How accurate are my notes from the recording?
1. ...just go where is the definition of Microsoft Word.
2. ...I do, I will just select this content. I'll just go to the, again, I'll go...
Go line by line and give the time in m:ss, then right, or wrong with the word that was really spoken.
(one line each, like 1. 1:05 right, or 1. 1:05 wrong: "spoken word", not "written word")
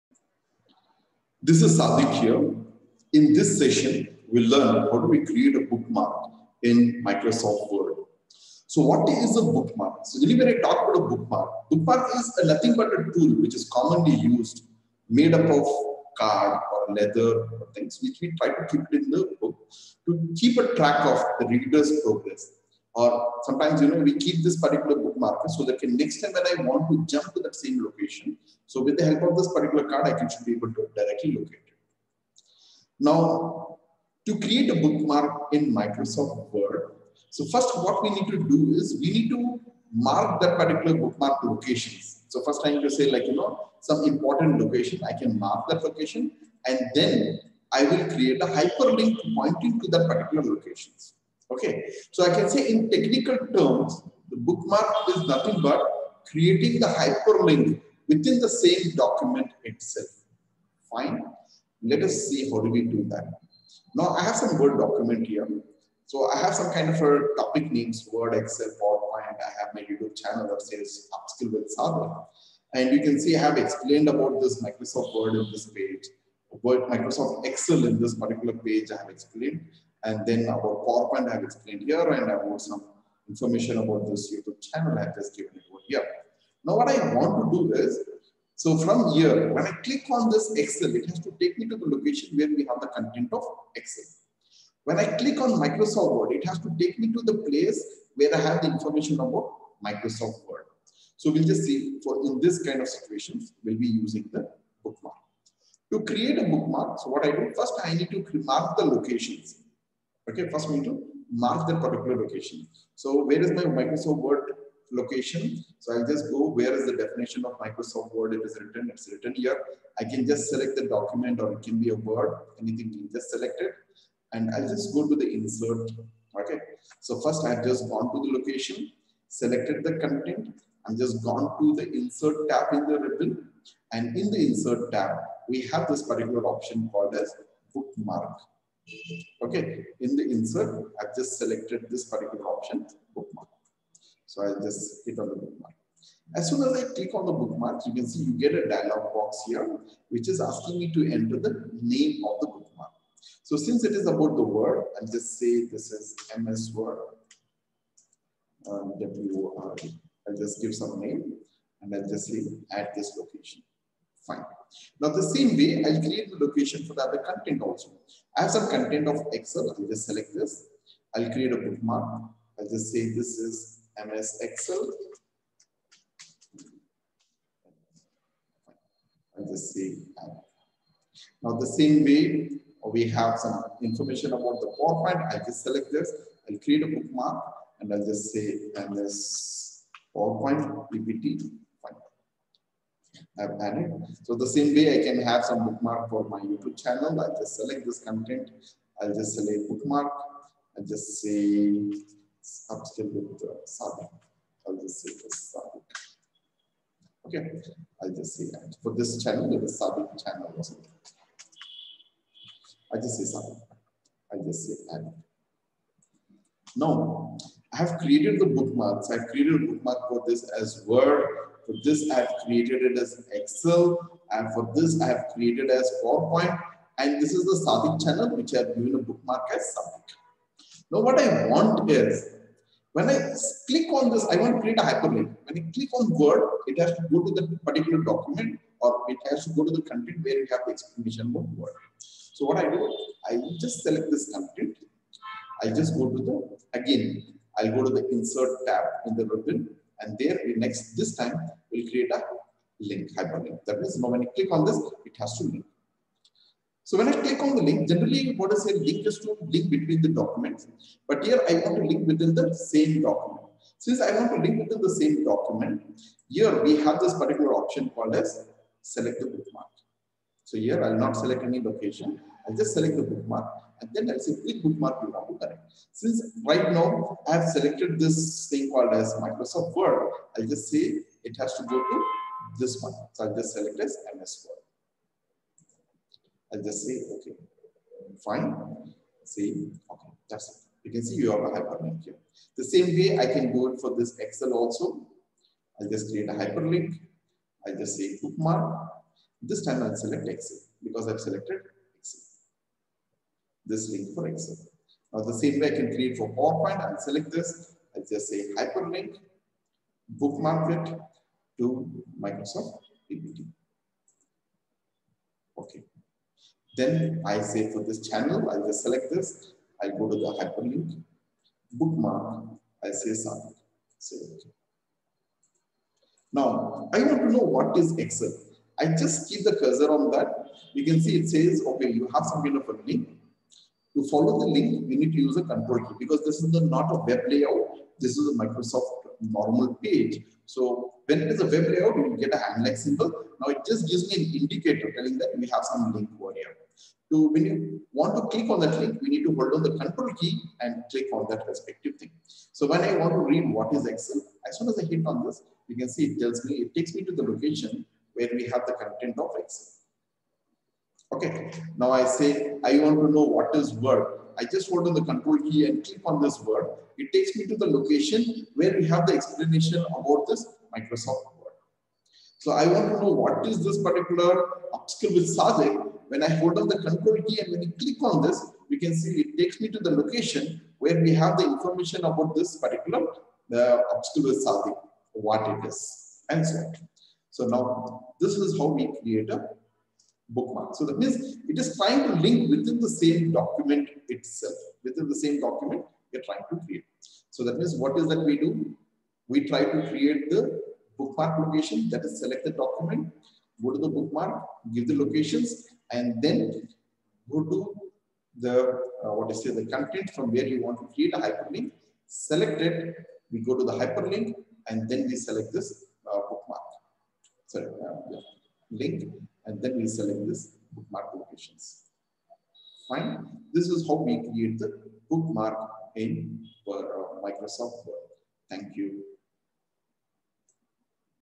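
1. 1:56 right
2. 4:02 right.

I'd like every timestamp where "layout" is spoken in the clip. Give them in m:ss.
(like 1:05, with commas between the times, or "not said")
5:37, 5:41.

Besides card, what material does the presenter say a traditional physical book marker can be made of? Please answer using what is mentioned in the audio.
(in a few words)
Leather.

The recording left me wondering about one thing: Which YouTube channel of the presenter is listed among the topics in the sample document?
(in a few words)
Upskill with Sadiq.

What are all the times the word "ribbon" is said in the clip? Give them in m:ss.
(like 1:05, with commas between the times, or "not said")
2:12, 4:09.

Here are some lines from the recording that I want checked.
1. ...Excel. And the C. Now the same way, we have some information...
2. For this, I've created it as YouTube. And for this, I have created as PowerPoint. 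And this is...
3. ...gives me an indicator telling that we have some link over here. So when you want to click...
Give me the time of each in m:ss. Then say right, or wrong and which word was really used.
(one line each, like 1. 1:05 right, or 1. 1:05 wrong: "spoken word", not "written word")
1. 2:54 right
2. 3:41 wrong: "Excel", not "YouTube"
3. 5:43 right.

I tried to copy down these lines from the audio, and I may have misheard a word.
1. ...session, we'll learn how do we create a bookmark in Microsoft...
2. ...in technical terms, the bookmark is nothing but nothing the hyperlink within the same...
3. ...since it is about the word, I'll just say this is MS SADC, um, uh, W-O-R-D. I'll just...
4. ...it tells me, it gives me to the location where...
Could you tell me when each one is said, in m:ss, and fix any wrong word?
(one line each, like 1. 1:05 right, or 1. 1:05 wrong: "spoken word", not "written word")
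1. 0:03 right
2. 0:52 wrong: "creating", not "nothing"
3. 2:33 wrong: "Word", not "SADC"
4. 5:56 wrong: "takes", not "gives".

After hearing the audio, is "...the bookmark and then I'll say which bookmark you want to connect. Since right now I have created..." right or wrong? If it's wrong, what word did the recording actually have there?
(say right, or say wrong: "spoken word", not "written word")
wrong: "selected", not "created".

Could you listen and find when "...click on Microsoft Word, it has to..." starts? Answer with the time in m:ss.
1:35.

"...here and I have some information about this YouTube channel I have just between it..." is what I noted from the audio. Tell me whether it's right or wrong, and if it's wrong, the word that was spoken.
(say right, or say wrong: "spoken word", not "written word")
wrong: "given", not "between".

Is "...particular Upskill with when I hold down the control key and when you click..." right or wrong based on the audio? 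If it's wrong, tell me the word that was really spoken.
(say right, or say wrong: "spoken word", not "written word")
right.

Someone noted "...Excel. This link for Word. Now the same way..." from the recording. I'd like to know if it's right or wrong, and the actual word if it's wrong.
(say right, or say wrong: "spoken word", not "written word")
wrong: "Excel", not "Word".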